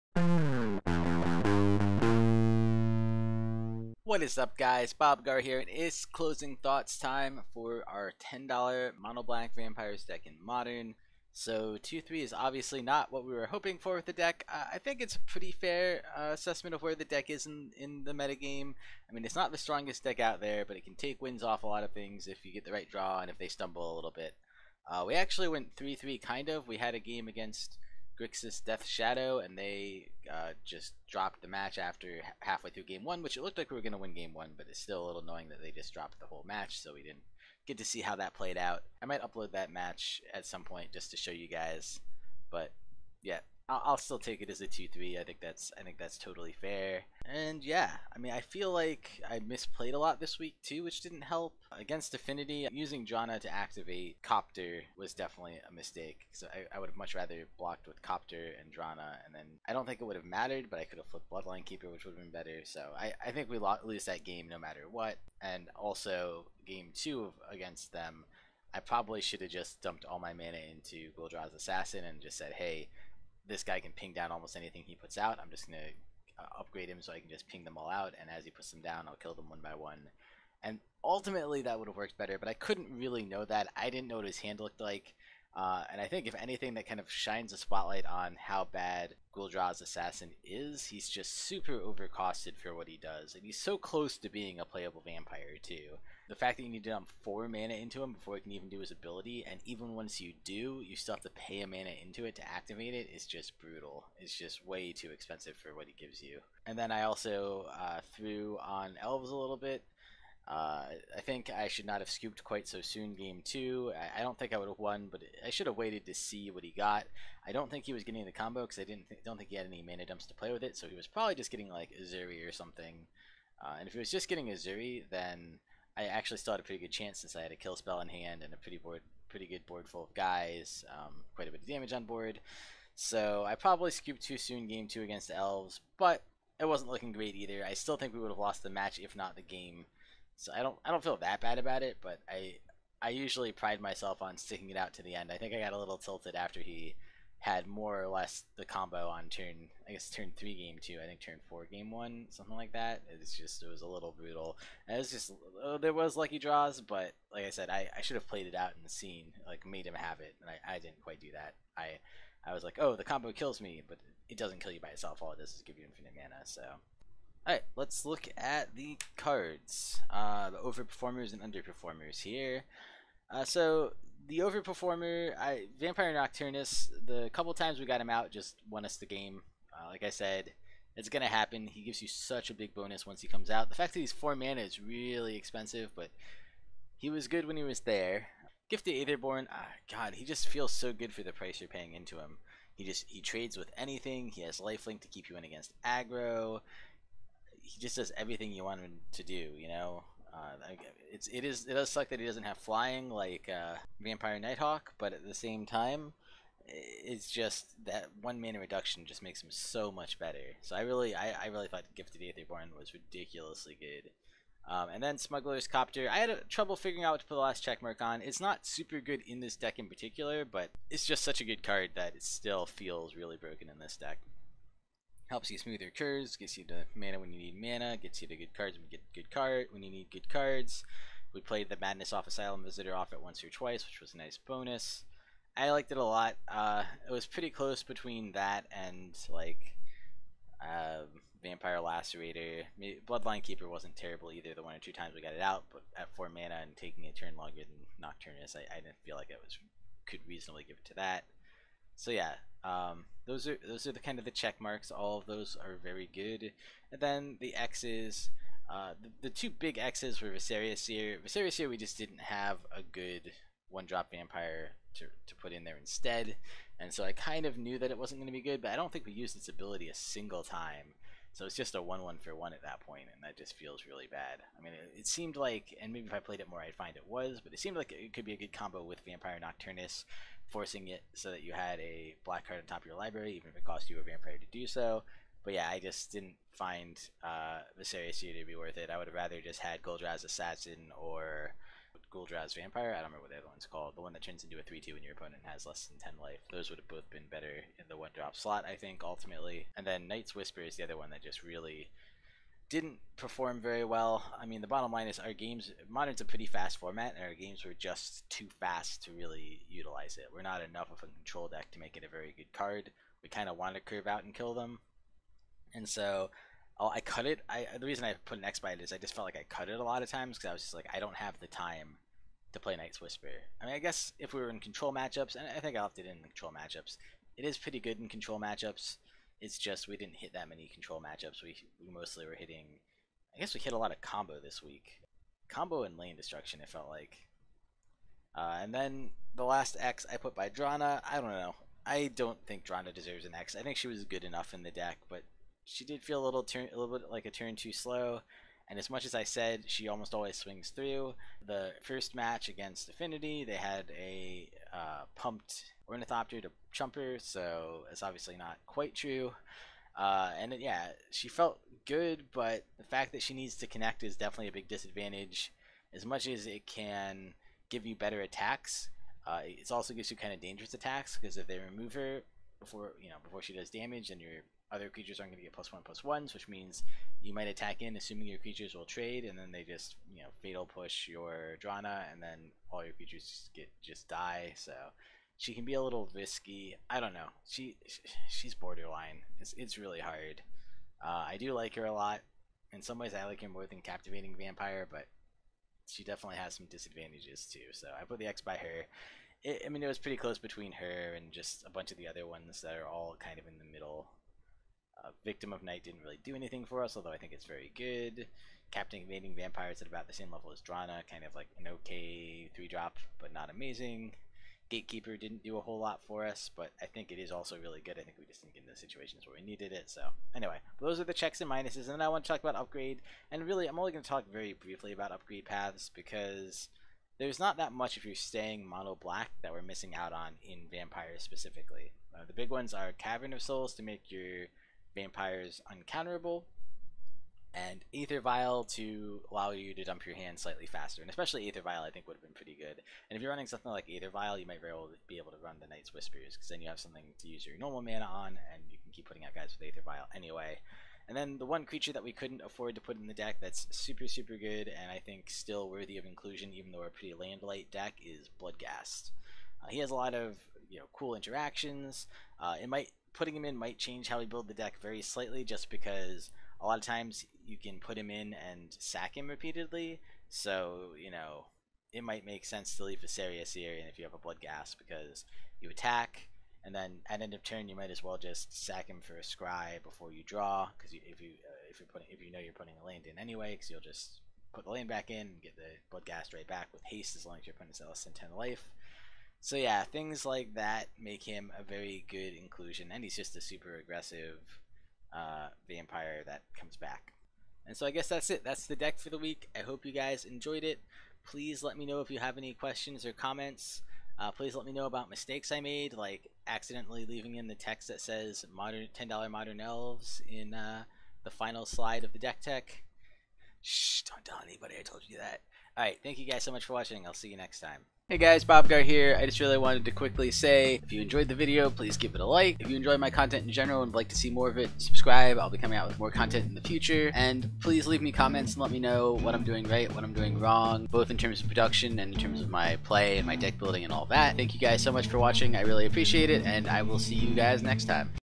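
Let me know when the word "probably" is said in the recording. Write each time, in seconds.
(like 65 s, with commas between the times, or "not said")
68 s, 121 s, 133 s.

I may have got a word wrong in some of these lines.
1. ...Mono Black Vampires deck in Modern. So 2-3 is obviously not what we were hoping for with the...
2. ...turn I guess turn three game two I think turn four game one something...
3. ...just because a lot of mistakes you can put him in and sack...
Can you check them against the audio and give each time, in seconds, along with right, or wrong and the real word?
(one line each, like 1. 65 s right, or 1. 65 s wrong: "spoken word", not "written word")
1. 9 s right
2. 149 s right
3. 465 s wrong: "times", not "mistakes".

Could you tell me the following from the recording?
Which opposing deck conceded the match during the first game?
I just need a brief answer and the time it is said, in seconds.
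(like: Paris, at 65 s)
Grixis Death Shadow, at 28 s.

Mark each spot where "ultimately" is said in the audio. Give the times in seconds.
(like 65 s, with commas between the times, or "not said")
81 s, 299 s.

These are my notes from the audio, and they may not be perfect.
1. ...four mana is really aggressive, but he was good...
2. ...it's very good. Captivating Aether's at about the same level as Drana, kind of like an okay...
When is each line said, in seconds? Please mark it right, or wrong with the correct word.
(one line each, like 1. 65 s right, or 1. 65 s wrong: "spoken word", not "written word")
1. 184 s wrong: "expensive", not "aggressive"
2. 407 s wrong: "Vampire", not "Aether".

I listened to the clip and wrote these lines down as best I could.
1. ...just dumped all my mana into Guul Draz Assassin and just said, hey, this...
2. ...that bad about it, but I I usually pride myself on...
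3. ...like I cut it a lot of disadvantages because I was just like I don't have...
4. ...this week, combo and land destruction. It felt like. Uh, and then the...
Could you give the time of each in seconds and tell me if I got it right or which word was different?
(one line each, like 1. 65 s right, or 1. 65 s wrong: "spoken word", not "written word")
1. 69 s right
2. 141 s right
3. 319 s wrong: "times", not "disadvantages"
4. 334 s right.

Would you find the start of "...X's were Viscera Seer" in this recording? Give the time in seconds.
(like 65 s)
259 s.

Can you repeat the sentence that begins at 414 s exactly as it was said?
Gatekeeper didn't do a whole lot for us, but I think it is also really good.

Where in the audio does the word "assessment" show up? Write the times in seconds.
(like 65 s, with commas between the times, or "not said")
16 s.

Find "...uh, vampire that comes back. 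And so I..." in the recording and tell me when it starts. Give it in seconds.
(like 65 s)
495 s.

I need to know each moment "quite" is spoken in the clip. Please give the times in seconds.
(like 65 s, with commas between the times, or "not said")
112 s, 131 s, 161 s, 358 s.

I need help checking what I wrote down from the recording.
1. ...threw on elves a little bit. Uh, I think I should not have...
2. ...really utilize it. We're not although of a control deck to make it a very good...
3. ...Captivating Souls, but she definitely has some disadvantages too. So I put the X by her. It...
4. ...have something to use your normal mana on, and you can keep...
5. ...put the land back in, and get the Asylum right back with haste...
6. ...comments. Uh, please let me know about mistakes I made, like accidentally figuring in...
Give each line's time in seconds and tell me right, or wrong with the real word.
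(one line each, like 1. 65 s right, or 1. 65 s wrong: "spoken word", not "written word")
1. 108 s right
2. 309 s wrong: "enough", not "although"
3. 393 s wrong: "Vampire", not "Souls"
4. 446 s right
5. 484 s wrong: "Bloodghast", not "Asylum"
6. 503 s wrong: "leaving", not "figuring".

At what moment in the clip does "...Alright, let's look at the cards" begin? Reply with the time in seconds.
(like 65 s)
167 s.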